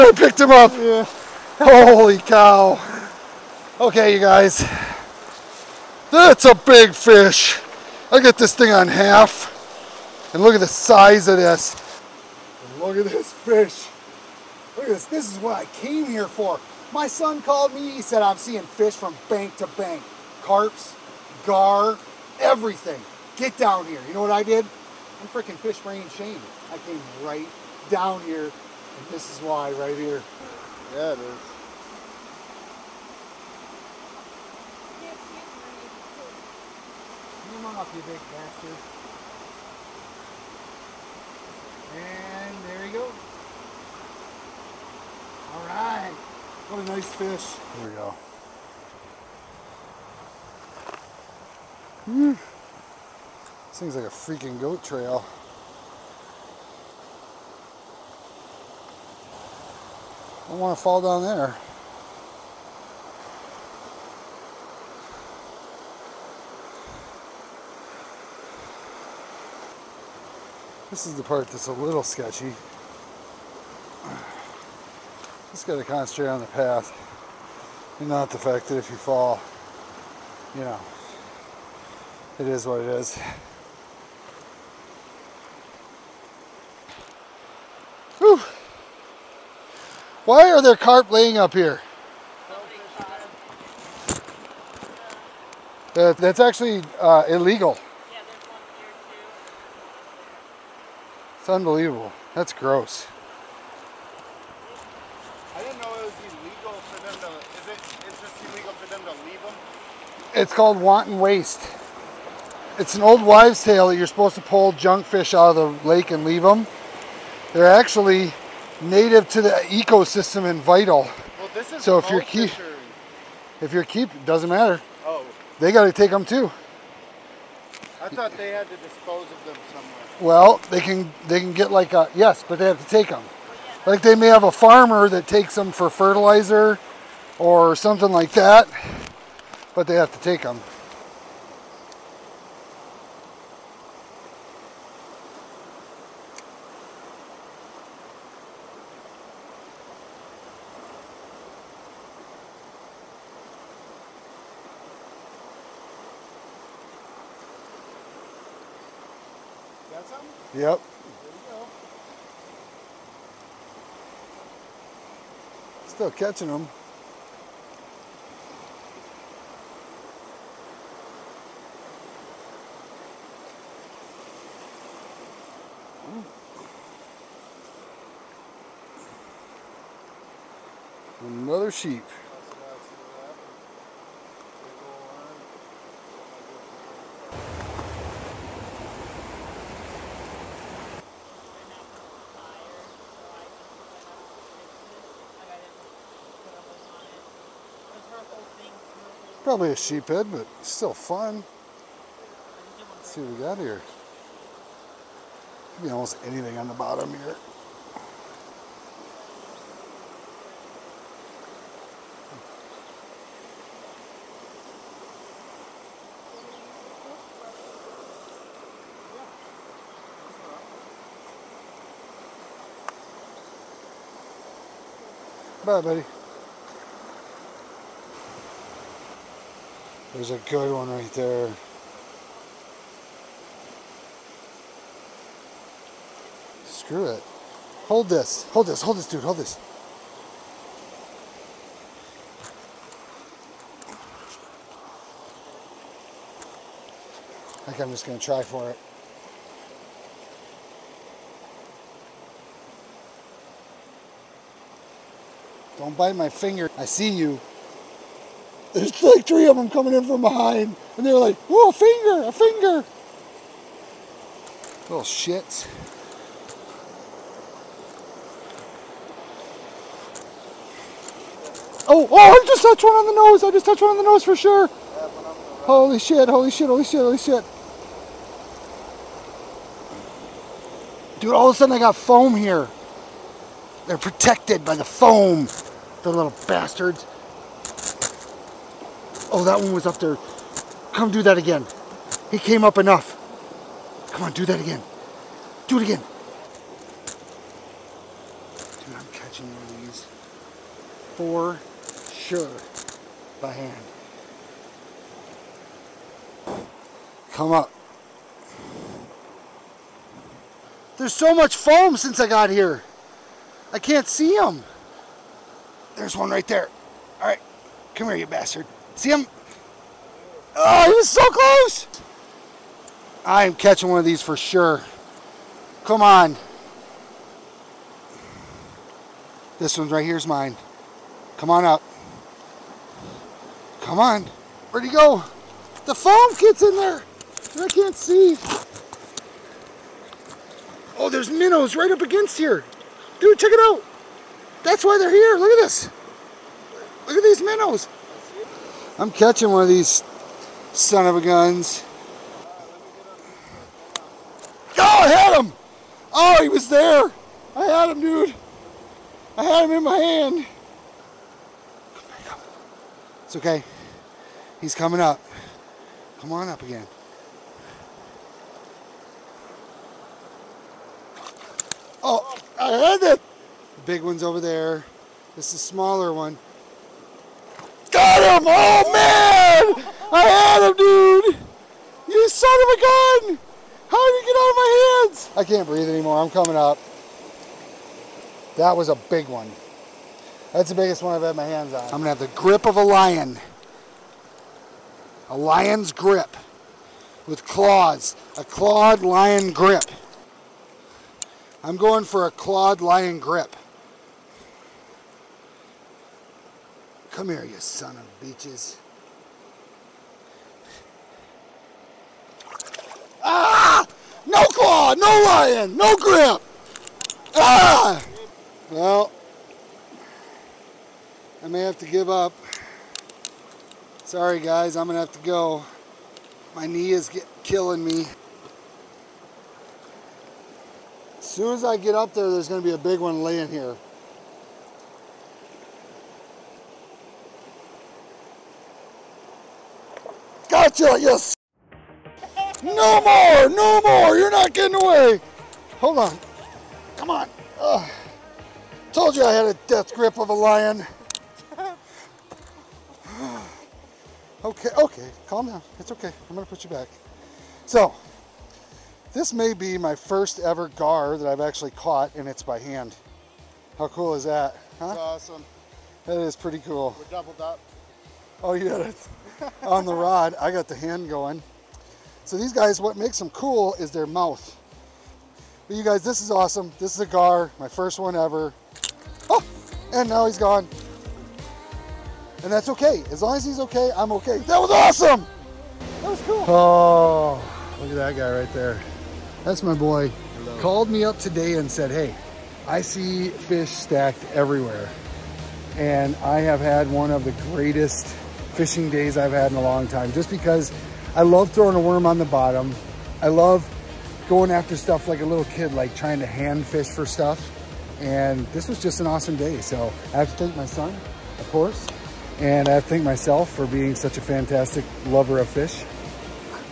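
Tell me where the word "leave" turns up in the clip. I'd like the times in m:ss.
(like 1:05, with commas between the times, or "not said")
1:49, 1:56.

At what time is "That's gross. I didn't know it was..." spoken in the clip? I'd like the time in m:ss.
1:42.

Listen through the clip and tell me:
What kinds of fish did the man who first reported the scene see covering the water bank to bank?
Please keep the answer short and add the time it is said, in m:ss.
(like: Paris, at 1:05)
Carps, gar, at 0:20.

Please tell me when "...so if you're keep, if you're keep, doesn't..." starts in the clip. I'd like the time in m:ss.
2:01.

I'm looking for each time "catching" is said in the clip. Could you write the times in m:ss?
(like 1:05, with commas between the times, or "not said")
2:46, 4:59, 5:23, 5:49.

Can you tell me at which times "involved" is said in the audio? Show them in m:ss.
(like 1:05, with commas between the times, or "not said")
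not said.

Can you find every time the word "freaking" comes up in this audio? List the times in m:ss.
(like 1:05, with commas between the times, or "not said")
0:25, 0:54.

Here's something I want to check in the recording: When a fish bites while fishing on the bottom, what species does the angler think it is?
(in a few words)
sheep head.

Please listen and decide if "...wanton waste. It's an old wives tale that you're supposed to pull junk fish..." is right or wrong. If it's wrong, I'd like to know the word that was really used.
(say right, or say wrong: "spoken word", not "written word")
right.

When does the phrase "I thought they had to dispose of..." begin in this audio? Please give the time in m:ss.
2:08.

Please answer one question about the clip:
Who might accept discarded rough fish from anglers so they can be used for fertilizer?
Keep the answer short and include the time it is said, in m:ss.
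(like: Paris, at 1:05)
a farmer, at 2:14.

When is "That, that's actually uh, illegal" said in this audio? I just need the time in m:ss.
1:35.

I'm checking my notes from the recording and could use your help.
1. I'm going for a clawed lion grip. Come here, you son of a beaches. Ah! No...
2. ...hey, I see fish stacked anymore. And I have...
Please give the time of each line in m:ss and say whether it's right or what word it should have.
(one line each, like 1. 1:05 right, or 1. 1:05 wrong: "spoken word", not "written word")
1. 6:41 right
2. 8:11 wrong: "everywhere", not "anymore".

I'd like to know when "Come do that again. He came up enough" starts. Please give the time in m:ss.
4:50.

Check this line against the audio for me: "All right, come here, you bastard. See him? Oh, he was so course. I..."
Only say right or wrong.
wrong.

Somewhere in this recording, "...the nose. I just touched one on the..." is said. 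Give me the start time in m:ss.
4:33.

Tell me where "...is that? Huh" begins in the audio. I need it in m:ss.
7:44.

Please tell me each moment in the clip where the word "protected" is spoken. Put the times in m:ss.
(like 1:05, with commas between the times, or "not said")
4:43.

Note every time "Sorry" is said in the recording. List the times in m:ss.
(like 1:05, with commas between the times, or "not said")
7:04.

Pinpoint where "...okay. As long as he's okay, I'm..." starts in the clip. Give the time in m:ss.
8:02.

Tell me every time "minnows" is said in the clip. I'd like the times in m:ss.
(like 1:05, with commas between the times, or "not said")
5:41, 5:47.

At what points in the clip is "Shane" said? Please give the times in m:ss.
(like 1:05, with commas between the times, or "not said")
0:26.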